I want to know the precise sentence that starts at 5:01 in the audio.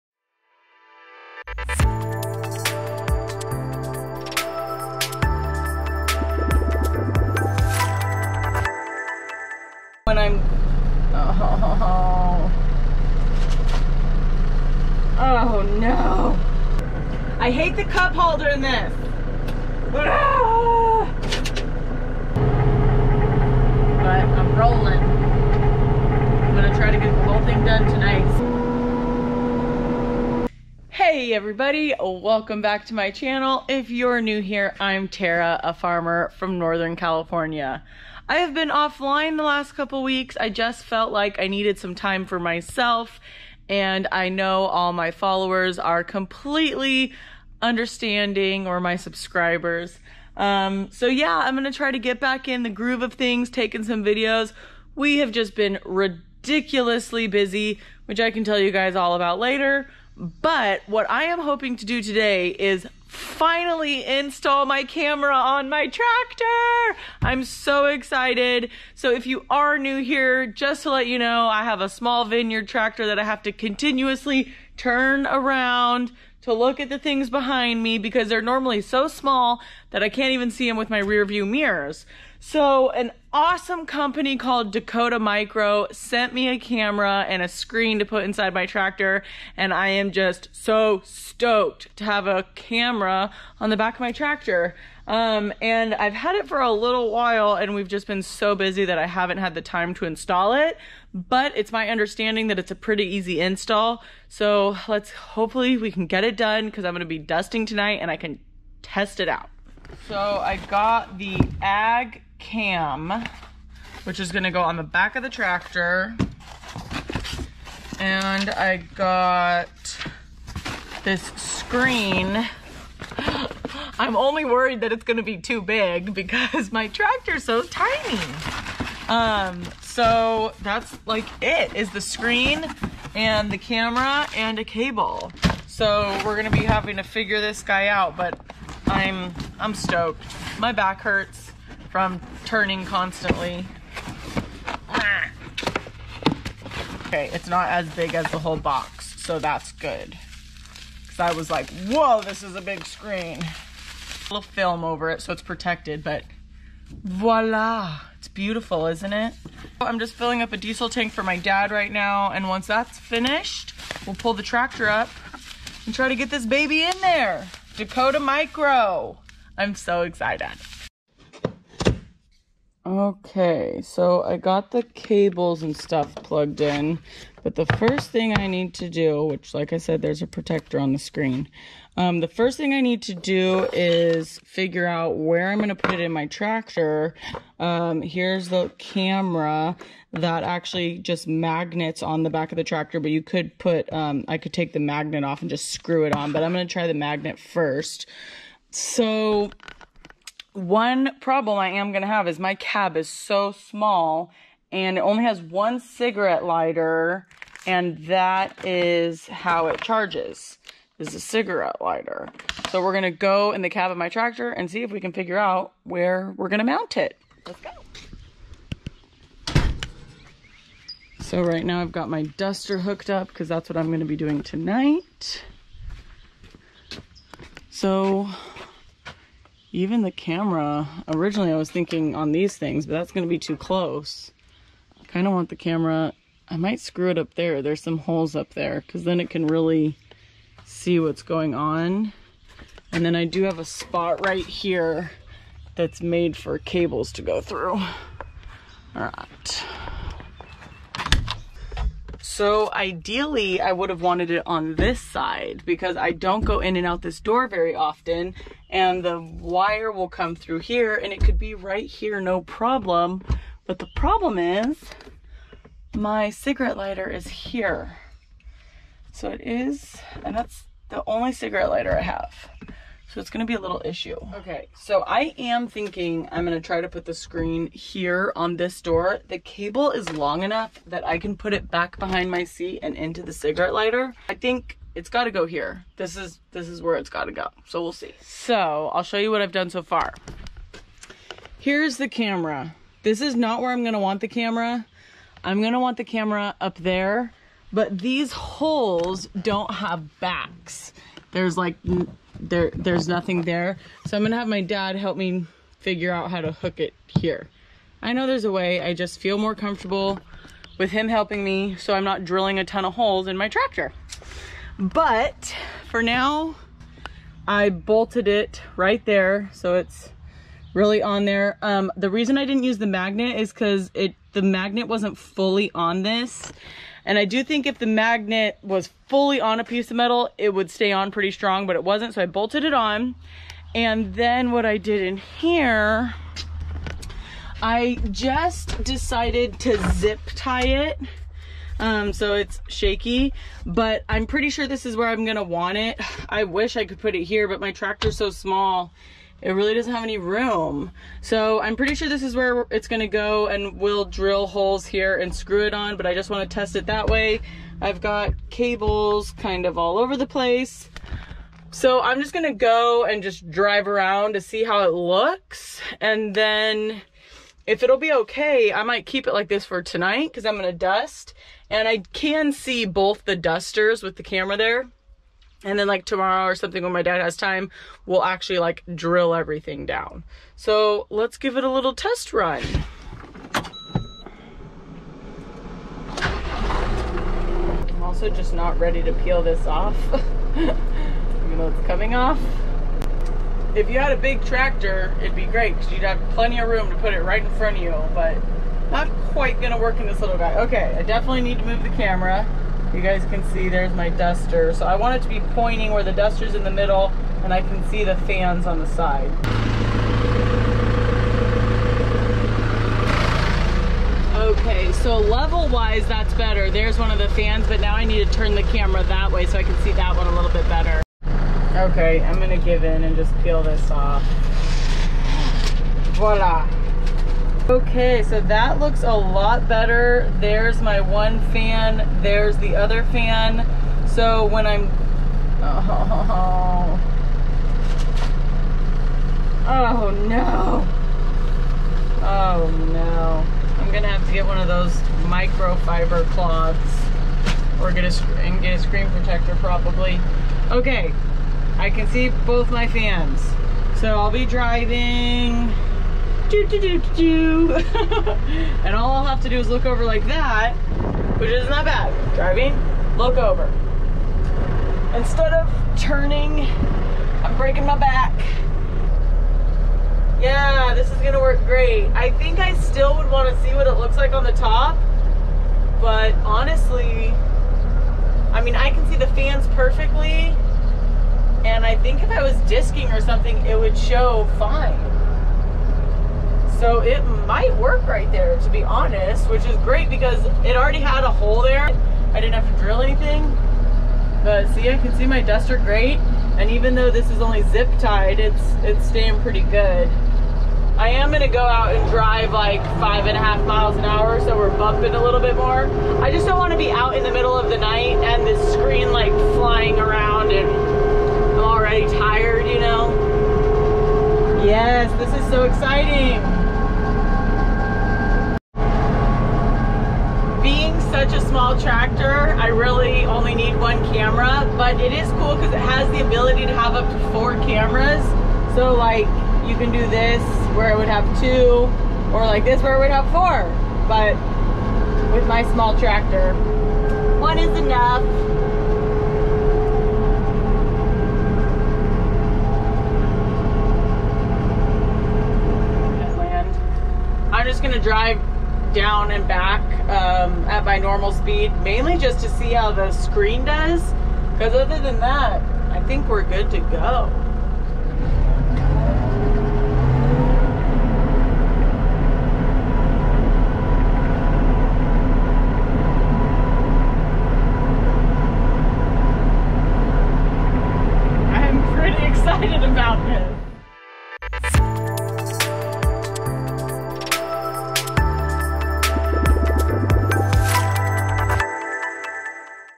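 There's like there there's nothing there.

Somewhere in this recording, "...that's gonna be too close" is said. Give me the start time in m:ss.
3:52.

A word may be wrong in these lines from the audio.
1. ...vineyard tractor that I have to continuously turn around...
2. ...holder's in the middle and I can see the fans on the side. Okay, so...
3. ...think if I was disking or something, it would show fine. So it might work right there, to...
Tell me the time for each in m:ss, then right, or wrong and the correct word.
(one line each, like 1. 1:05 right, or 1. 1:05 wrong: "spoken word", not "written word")
1. 1:12 right
2. 6:46 wrong: "duster", not "holder"
3. 8:01 right.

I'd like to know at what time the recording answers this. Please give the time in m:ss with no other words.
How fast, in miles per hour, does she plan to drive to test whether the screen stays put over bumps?
8:22.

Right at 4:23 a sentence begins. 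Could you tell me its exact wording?
But the problem is my cigarette lighter is here.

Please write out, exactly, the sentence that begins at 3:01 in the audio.
Um, the first thing I need to do is figure out where I'm going to put it in my tractor.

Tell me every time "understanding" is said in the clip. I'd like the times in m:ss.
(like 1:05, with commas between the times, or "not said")
0:47, 1:41.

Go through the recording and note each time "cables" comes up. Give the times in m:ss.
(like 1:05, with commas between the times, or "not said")
2:14, 2:54, 4:06, 4:39, 5:58.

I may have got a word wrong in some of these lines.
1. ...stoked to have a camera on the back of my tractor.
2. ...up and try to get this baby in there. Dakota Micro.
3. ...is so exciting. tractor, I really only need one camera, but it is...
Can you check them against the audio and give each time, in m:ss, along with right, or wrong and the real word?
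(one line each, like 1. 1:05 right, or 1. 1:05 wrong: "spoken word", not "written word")
1. 1:31 right
2. 2:44 right
3. 8:35 right.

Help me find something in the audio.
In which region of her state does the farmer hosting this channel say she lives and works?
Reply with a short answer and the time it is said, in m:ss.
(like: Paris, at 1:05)
Northern California, at 0:36.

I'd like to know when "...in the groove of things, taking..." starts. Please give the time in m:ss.
0:52.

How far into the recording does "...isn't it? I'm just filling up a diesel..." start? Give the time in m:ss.
2:38.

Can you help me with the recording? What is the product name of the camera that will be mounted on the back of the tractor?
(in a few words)
Ag cam.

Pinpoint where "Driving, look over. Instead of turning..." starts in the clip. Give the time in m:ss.
7:42.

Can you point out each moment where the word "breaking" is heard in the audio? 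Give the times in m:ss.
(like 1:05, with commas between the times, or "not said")
7:47.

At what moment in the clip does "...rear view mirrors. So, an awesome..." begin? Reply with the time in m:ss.
1:20.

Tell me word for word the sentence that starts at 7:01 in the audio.
Okay, I'm gonna give in and just peel this off.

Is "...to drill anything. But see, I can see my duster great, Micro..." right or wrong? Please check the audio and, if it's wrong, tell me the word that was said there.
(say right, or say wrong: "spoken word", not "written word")
wrong: "And", not "Micro".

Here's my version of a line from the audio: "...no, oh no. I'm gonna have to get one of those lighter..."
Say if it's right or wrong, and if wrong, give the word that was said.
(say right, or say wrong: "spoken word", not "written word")
wrong: "microfiber", not "lighter".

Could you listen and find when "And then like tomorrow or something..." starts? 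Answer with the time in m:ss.
6:15.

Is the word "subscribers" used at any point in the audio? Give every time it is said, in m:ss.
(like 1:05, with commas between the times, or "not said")
0:48.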